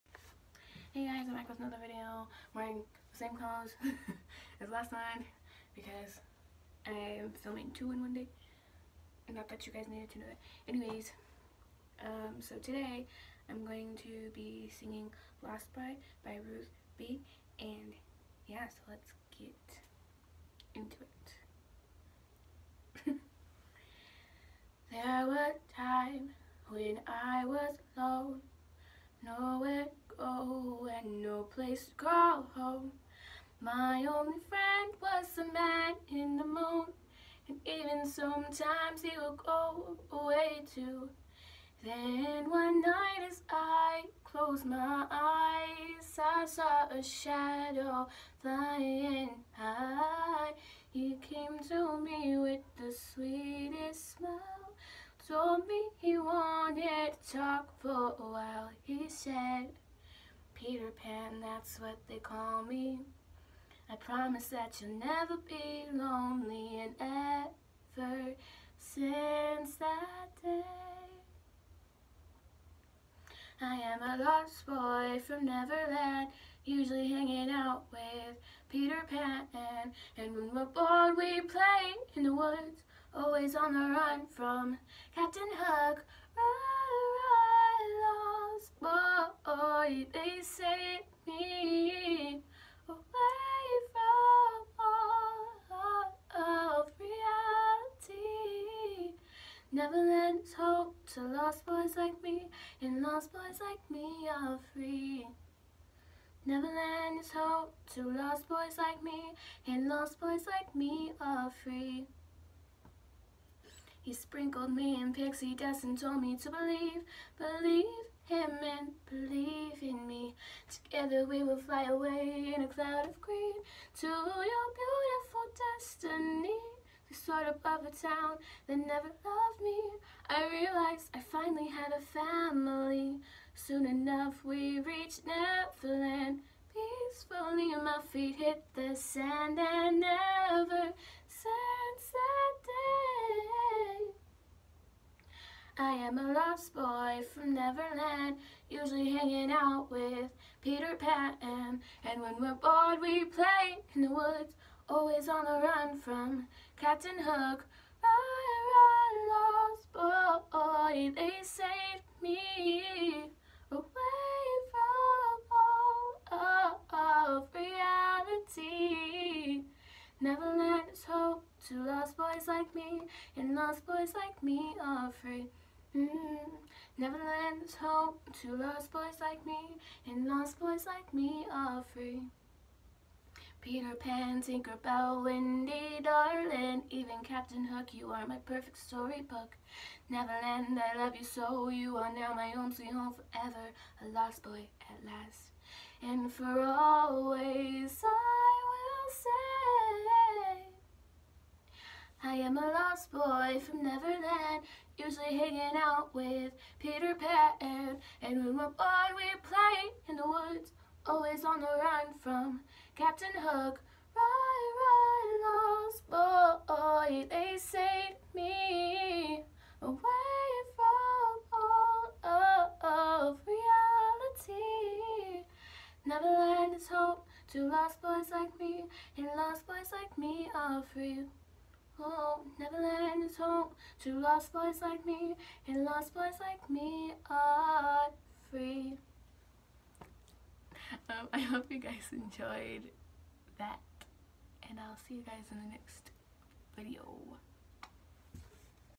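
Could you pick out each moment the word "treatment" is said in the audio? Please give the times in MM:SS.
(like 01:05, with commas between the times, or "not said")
not said.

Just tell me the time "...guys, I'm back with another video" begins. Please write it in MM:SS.
00:01.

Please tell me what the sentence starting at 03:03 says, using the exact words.
Peter Pan, Tinker Bell, Wendy, darling, even Captain Hook, you are my perfect storybook.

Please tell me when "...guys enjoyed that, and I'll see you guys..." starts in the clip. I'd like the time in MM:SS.
04:01.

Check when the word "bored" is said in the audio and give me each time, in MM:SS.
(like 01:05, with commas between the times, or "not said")
01:20, 02:32, 03:28.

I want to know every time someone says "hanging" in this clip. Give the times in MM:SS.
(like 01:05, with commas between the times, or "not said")
01:17, 02:29, 03:25.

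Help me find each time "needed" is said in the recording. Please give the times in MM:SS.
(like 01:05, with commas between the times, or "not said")
00:09.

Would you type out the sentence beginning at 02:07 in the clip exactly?
The sort of a town that never loved me.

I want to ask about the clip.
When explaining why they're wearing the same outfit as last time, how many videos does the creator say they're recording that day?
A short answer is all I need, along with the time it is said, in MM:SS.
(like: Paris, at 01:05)
2, at 00:07.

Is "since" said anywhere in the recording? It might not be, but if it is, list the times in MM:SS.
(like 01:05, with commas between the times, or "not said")
01:08.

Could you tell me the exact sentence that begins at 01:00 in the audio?
Peter Pan, that's what they call me.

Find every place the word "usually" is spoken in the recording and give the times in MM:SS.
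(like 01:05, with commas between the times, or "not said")
01:16, 02:28, 03:24.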